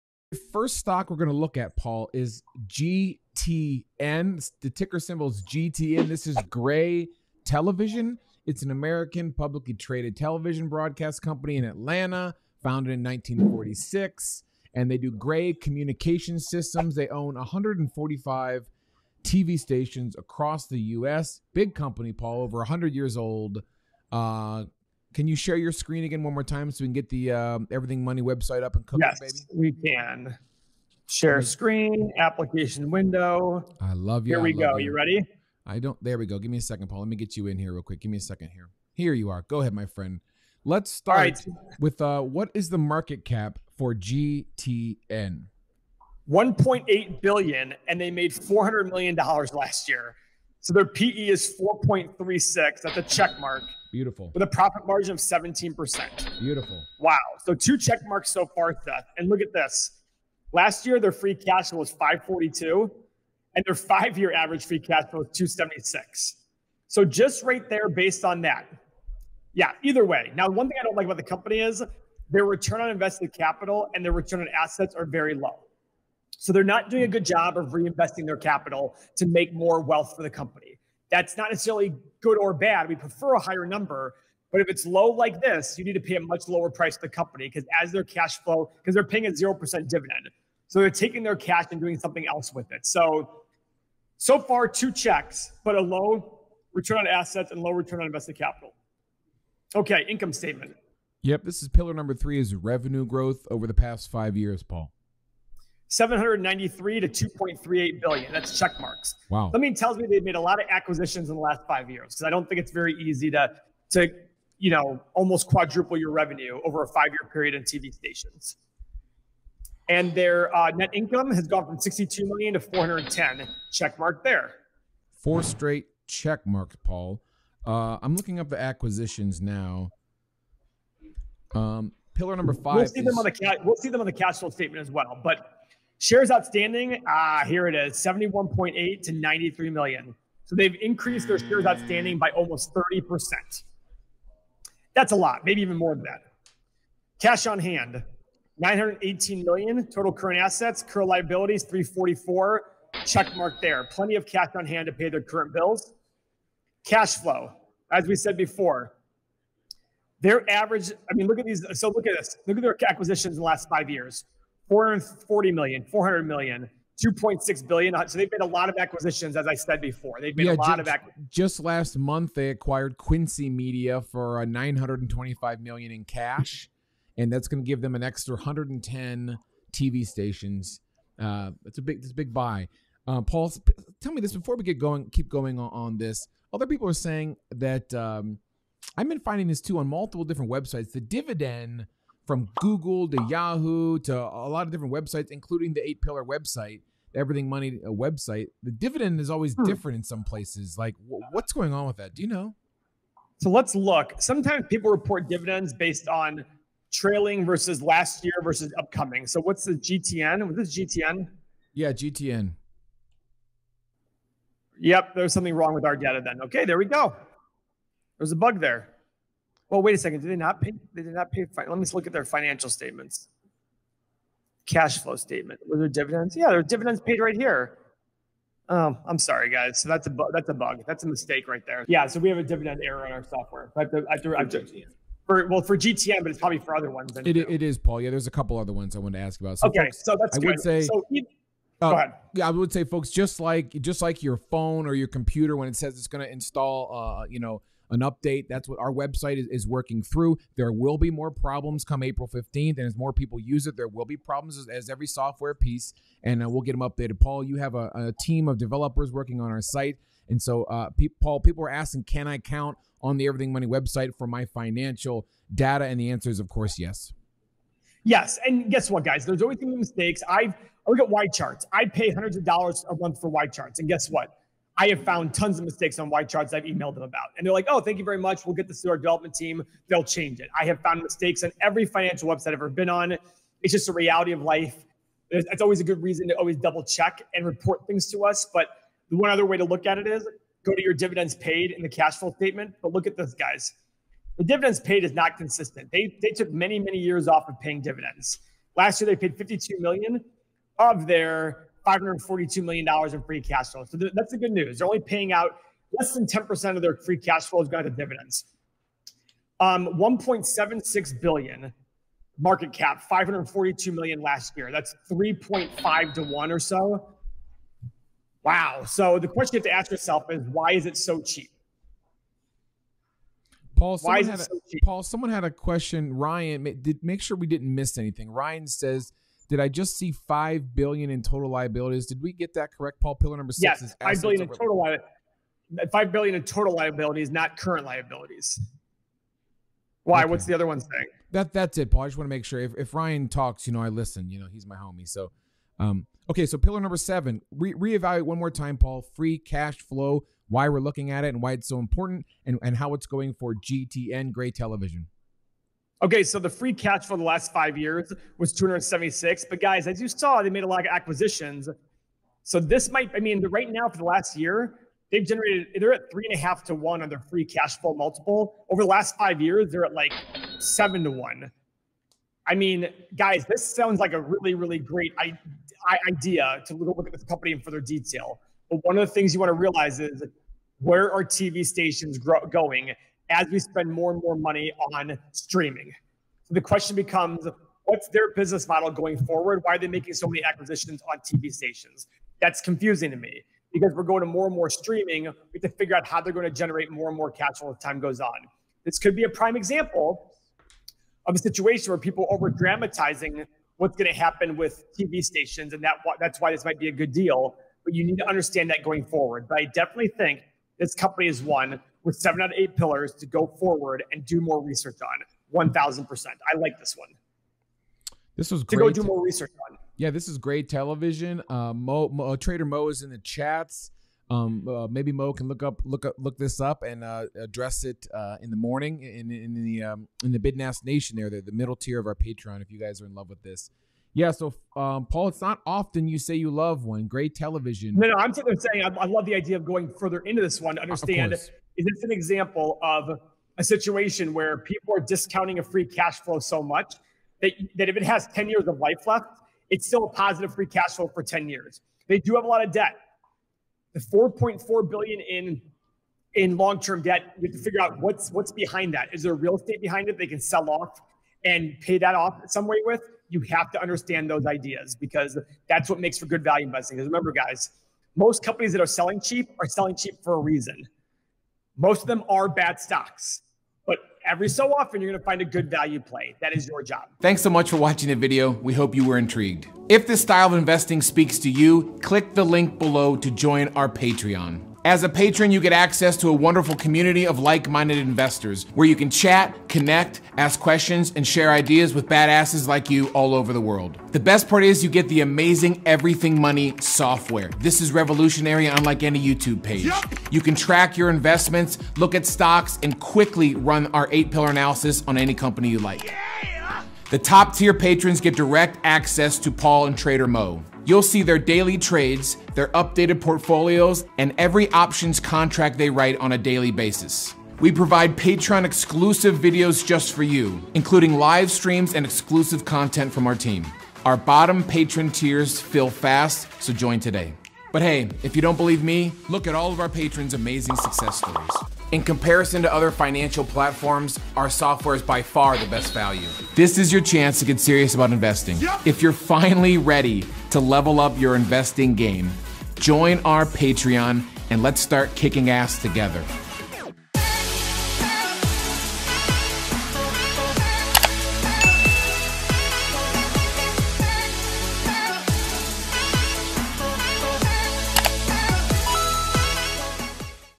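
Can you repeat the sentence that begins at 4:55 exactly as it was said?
They, they took many, many years off of paying dividends.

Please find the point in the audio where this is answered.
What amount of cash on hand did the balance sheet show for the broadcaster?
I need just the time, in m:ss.
2:28.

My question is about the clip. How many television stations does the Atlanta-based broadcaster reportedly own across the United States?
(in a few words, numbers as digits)
145.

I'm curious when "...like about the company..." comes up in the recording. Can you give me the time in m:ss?
1:10.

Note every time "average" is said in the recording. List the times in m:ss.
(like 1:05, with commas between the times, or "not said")
1:04, 2:40.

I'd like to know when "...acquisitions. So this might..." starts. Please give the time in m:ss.
6:00.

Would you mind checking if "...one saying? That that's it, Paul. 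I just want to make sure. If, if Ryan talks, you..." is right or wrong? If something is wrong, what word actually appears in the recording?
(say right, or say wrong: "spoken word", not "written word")
right.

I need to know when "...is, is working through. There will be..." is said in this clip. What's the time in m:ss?
4:09.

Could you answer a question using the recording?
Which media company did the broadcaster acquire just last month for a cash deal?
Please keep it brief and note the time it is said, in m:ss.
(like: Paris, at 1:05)
Quincy Media, at 2:52.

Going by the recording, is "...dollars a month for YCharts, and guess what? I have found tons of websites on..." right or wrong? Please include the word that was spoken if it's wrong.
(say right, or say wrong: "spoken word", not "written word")
wrong: "mistakes", not "websites".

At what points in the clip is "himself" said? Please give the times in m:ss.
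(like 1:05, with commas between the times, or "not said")
not said.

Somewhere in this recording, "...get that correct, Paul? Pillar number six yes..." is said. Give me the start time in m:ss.
5:32.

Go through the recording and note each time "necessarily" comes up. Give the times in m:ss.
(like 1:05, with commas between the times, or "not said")
1:21.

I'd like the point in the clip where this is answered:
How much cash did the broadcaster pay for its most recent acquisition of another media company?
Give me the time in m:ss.
2:54.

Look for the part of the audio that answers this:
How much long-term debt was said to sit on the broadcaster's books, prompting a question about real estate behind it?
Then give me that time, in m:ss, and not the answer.
7:33.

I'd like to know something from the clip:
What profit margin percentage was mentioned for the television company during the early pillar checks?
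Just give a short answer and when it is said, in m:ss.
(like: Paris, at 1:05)
17%, at 0:55.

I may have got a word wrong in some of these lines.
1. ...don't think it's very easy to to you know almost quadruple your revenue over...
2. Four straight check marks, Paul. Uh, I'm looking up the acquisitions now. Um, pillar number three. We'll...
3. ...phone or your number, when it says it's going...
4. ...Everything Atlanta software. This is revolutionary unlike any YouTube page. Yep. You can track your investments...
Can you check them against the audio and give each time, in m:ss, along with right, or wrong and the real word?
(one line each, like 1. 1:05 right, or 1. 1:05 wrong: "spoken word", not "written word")
1. 1:52 right
2. 2:05 wrong: "five", not "three"
3. 4:04 wrong: "computer", not "number"
4. 8:15 wrong: "Money", not "Atlanta".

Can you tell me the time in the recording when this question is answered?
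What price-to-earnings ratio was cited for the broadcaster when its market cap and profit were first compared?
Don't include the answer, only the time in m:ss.
0:51.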